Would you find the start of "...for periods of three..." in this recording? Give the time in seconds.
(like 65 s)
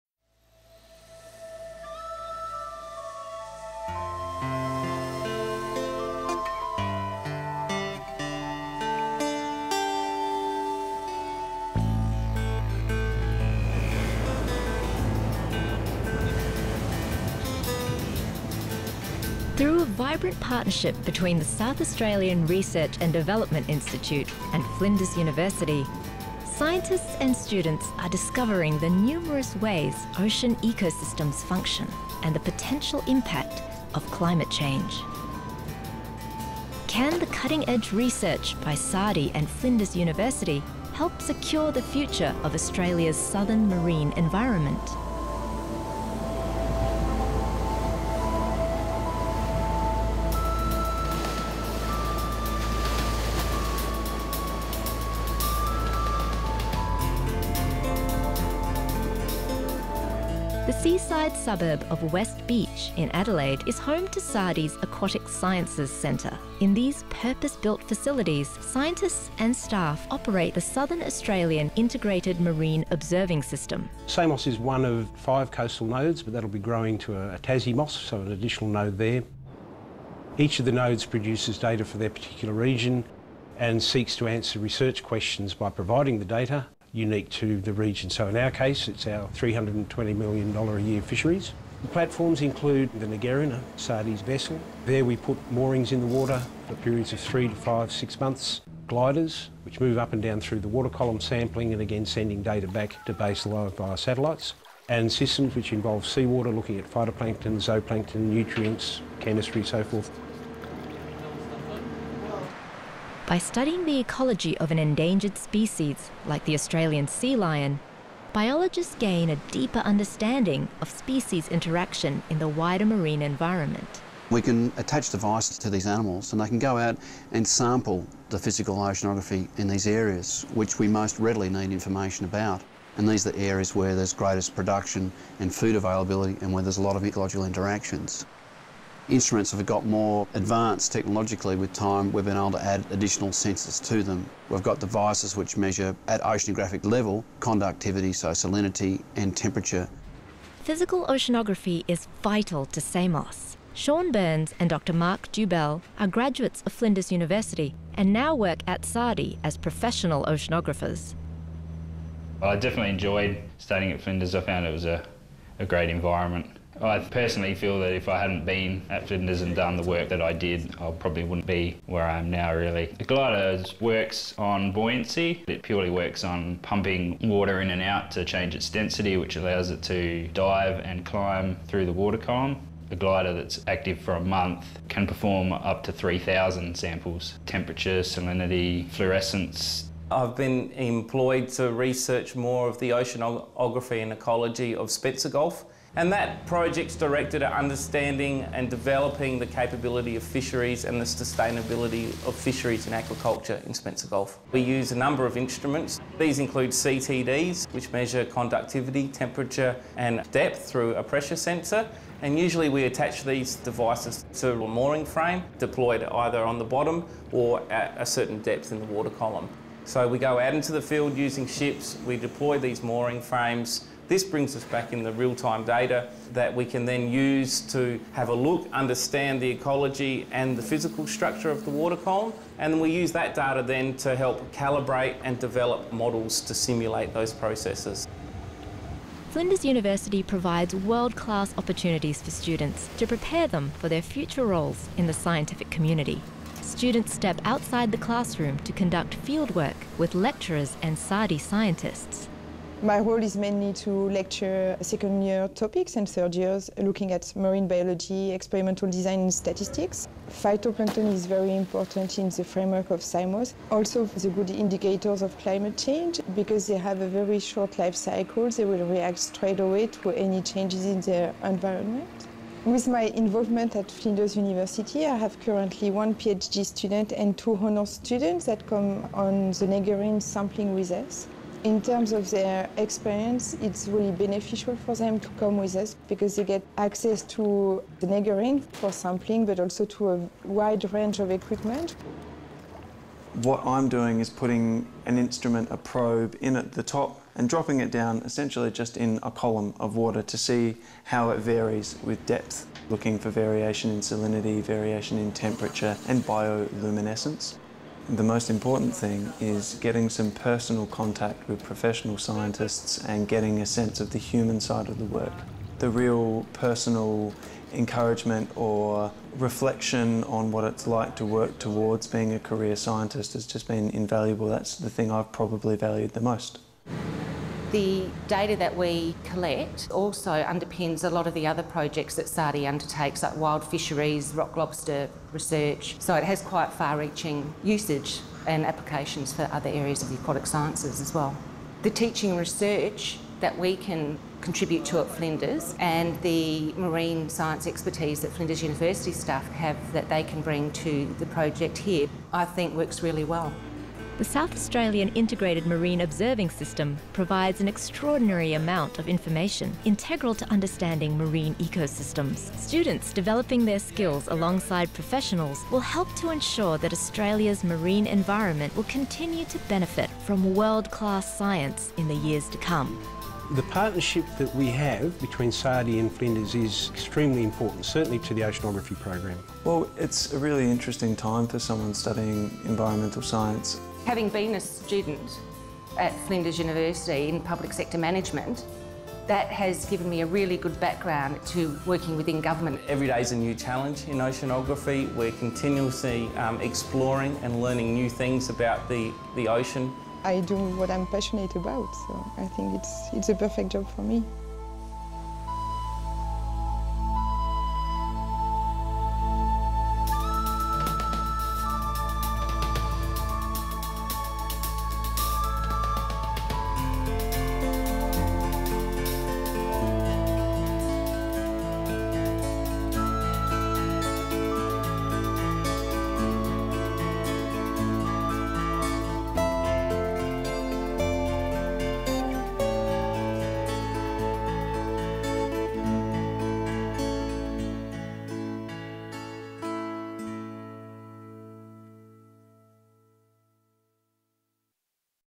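96 s.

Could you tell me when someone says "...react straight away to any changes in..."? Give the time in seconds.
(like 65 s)
268 s.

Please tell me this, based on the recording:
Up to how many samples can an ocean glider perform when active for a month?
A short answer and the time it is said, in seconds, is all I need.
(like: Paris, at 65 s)
3,000, at 185 s.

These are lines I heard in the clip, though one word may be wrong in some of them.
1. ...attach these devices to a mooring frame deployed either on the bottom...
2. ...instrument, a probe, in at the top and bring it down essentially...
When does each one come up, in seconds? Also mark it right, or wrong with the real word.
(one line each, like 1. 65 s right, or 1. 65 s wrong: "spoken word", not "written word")
1. 212 s right
2. 295 s wrong: "dropping", not "bring".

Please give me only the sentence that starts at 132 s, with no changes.
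And these are the areas where there's greatest production and food availability and where there's a lot of ecological interactions.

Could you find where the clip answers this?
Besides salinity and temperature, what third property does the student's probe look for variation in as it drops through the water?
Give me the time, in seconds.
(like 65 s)
306 s.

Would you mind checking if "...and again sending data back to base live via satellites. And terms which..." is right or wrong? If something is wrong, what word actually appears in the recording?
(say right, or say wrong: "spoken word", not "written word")
wrong: "systems", not "terms".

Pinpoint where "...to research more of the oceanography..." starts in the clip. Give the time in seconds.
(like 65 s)
191 s.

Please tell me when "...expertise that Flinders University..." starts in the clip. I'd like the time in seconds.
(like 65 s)
347 s.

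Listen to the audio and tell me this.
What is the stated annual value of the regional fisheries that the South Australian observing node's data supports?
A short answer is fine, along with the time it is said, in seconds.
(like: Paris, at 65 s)
$320 million, at 89 s.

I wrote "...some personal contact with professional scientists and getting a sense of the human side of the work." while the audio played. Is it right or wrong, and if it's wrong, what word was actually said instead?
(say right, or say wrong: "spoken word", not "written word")
right.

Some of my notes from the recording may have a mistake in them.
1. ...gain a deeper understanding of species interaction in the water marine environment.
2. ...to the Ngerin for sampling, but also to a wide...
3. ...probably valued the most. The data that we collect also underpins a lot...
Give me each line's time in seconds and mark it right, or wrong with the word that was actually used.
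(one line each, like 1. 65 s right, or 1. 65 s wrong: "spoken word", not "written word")
1. 118 s wrong: "wider", not "water"
2. 287 s right
3. 325 s right.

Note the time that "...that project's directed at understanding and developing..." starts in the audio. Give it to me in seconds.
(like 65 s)
196 s.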